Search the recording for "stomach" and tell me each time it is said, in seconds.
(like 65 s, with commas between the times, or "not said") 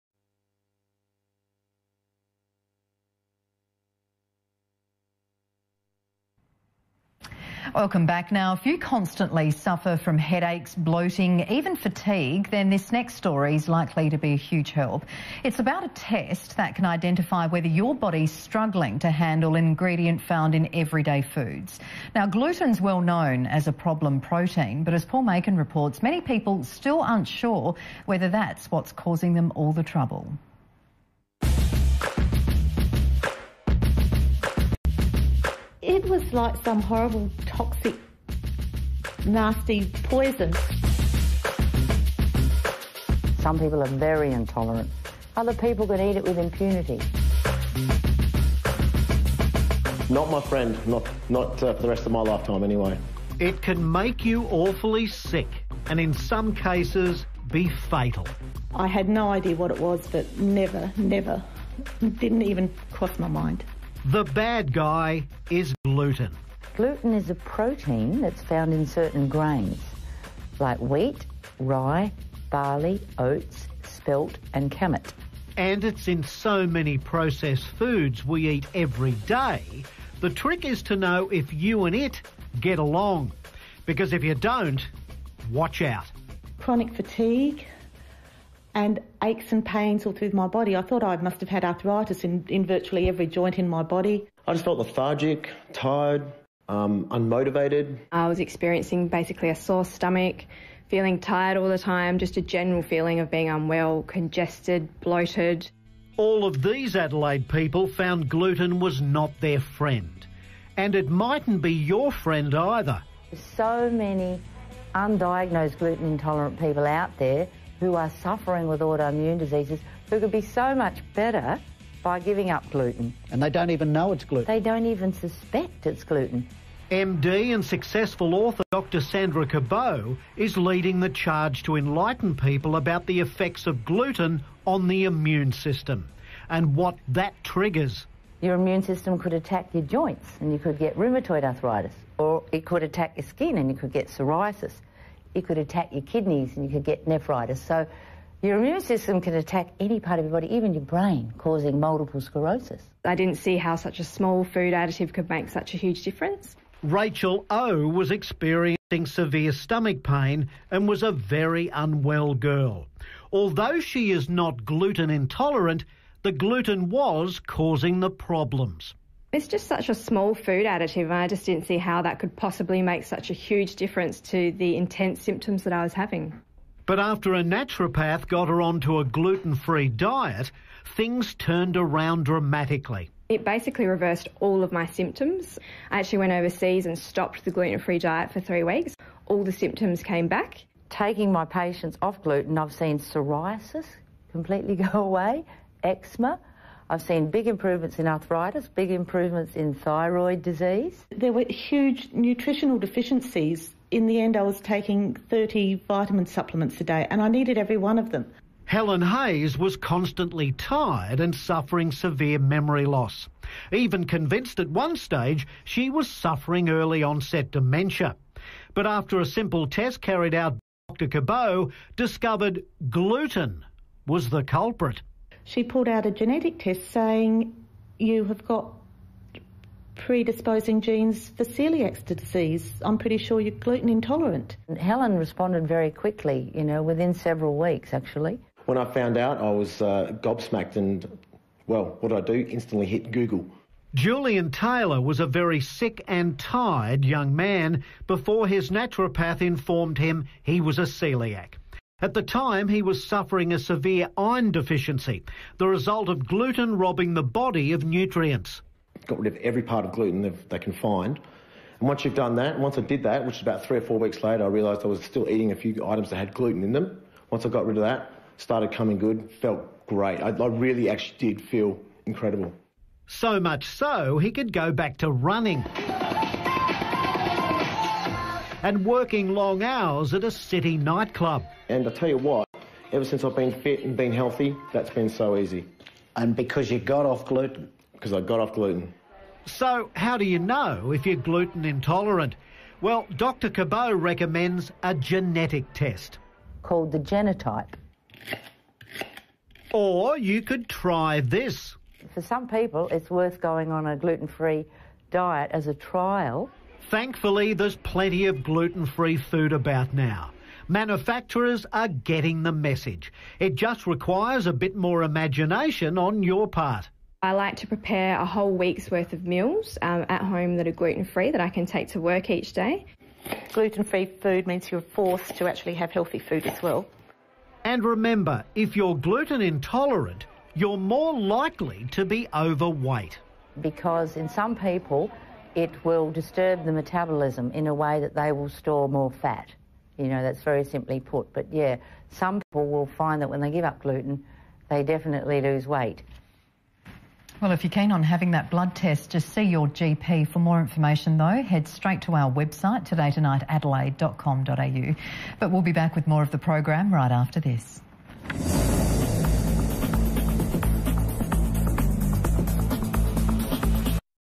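99 s, 159 s.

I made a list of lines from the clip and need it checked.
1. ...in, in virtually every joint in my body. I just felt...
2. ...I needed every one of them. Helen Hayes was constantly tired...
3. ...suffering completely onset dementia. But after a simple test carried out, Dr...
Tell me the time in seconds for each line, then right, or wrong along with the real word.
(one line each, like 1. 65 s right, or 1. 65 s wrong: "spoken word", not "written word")
1. 92 s right
2. 207 s right
3. 216 s wrong: "early", not "completely".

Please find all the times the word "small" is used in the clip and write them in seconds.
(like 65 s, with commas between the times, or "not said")
154 s, 169 s.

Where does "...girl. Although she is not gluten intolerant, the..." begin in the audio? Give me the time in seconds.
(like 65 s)
162 s.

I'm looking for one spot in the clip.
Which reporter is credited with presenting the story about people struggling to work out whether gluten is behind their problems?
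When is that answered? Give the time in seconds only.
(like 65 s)
25 s.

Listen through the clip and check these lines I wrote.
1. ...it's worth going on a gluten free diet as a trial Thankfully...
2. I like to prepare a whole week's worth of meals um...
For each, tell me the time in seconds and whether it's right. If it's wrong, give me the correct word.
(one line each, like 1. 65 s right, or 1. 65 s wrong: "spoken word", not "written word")
1. 302 s right
2. 317 s right.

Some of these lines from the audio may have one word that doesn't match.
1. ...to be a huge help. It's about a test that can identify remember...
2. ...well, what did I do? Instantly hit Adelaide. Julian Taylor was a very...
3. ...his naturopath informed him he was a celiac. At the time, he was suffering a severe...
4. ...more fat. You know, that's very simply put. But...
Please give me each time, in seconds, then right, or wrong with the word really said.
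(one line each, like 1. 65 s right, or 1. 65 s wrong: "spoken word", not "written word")
1. 14 s wrong: "whether", not "remember"
2. 241 s wrong: "Google", not "Adelaide"
3. 248 s right
4. 338 s right.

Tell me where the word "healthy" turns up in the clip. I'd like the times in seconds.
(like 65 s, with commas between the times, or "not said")
284 s, 325 s.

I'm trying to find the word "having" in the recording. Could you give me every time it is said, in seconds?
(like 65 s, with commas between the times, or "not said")
175 s, 348 s.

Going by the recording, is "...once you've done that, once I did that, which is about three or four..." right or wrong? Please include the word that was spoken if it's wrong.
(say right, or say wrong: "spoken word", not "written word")
right.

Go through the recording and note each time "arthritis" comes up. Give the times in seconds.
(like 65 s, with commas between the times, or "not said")
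91 s, 141 s, 198 s.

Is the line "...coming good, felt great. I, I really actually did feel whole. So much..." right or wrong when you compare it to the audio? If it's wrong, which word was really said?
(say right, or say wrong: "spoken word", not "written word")
wrong: "incredible", not "whole".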